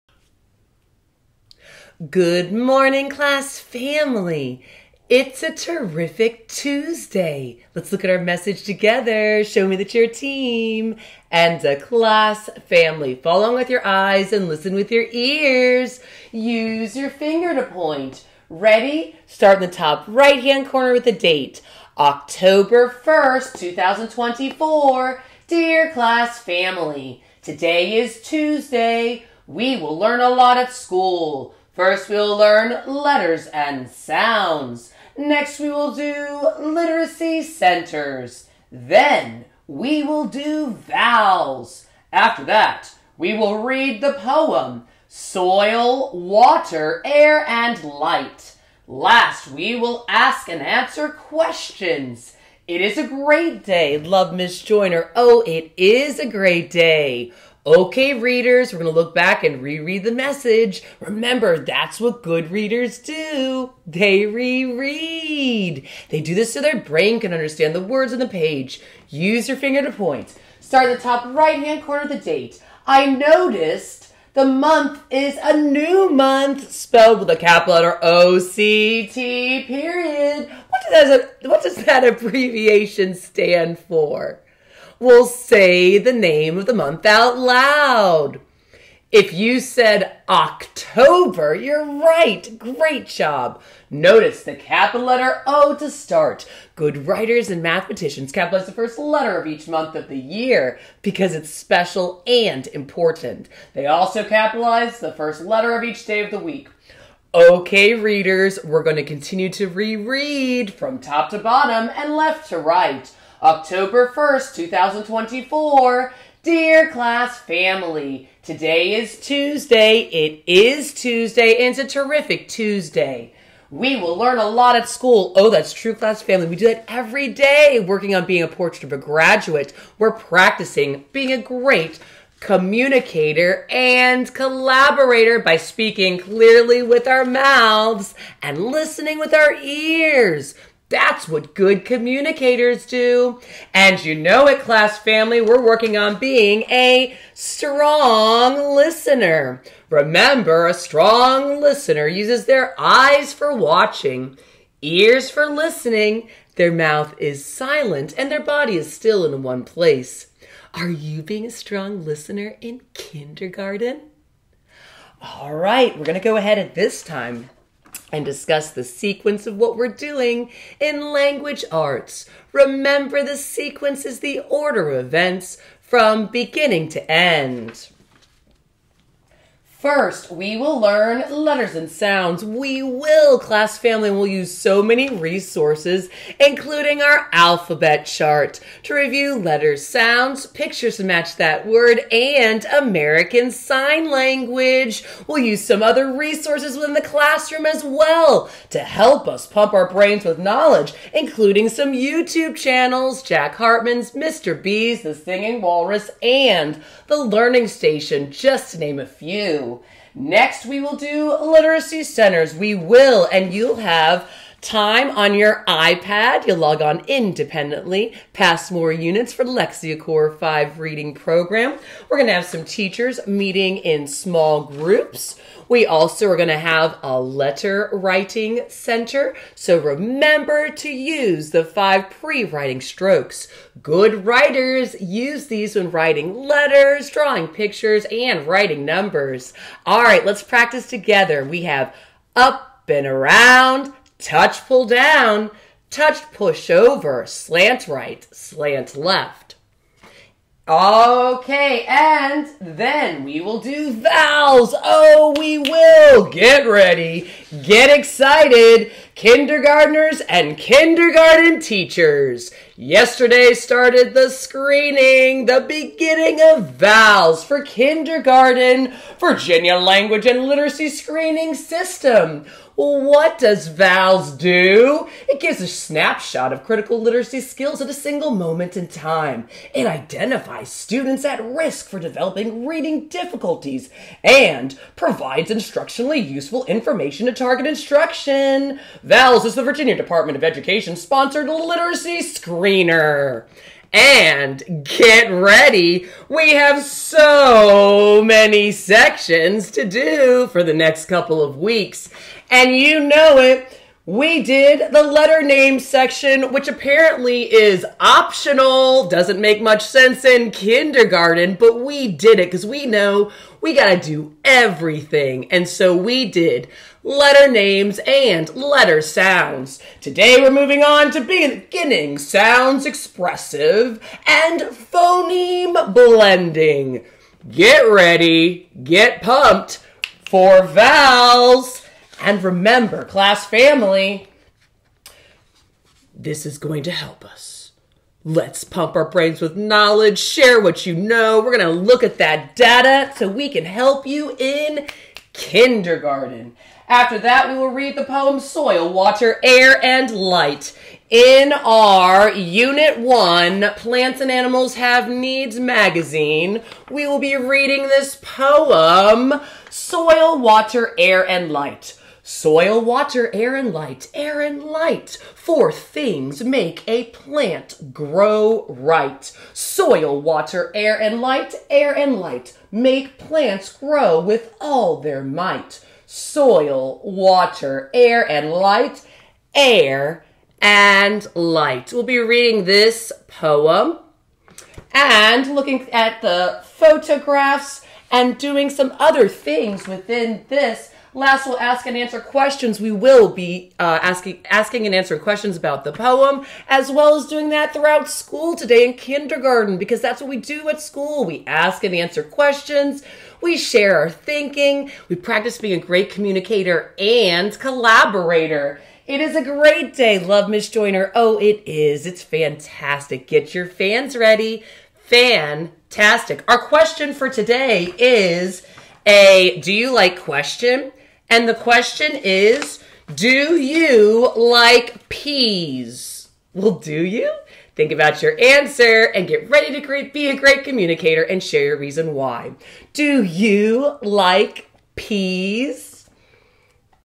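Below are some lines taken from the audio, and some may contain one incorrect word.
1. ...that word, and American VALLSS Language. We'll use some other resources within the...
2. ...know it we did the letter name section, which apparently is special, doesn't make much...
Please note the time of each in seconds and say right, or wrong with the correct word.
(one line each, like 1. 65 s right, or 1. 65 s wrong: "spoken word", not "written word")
1. 191 s wrong: "Sign", not "VALLSS"
2. 303 s wrong: "optional", not "special".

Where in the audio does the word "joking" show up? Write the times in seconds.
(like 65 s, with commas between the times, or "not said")
not said.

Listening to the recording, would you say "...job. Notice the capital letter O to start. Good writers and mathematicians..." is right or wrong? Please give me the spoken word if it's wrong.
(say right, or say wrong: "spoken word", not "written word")
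right.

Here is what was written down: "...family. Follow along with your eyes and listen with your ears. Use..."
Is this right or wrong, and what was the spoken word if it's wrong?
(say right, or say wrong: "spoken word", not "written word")
right.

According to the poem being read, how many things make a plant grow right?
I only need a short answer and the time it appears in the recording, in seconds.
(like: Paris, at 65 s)
4, at 365 s.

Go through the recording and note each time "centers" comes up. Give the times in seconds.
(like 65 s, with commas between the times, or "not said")
37 s, 212 s, 228 s.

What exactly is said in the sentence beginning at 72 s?
I noticed the month is a new month spelled with a capital letter O C T period.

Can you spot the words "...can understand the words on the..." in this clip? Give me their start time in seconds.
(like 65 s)
67 s.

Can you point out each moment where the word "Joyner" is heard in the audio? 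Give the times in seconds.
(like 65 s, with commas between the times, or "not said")
54 s, 410 s.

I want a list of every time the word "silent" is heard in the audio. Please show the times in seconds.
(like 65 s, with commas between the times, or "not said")
157 s.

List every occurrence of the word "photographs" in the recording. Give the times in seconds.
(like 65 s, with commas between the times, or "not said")
386 s.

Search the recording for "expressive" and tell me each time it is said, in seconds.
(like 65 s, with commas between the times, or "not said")
322 s.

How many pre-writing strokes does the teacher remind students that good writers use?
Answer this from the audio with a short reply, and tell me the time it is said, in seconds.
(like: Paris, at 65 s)
5, at 231 s.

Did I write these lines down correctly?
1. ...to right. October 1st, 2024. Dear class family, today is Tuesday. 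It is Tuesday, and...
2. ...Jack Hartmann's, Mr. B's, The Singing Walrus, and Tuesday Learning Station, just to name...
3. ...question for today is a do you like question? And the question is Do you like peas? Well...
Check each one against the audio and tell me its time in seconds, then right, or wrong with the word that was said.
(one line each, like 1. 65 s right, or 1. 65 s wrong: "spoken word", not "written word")
1. 112 s right
2. 203 s wrong: "The", not "Tuesday"
3. 416 s right.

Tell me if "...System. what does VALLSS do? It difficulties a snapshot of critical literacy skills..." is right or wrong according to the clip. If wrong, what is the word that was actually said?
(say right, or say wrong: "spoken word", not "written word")
wrong: "gives", not "difficulties".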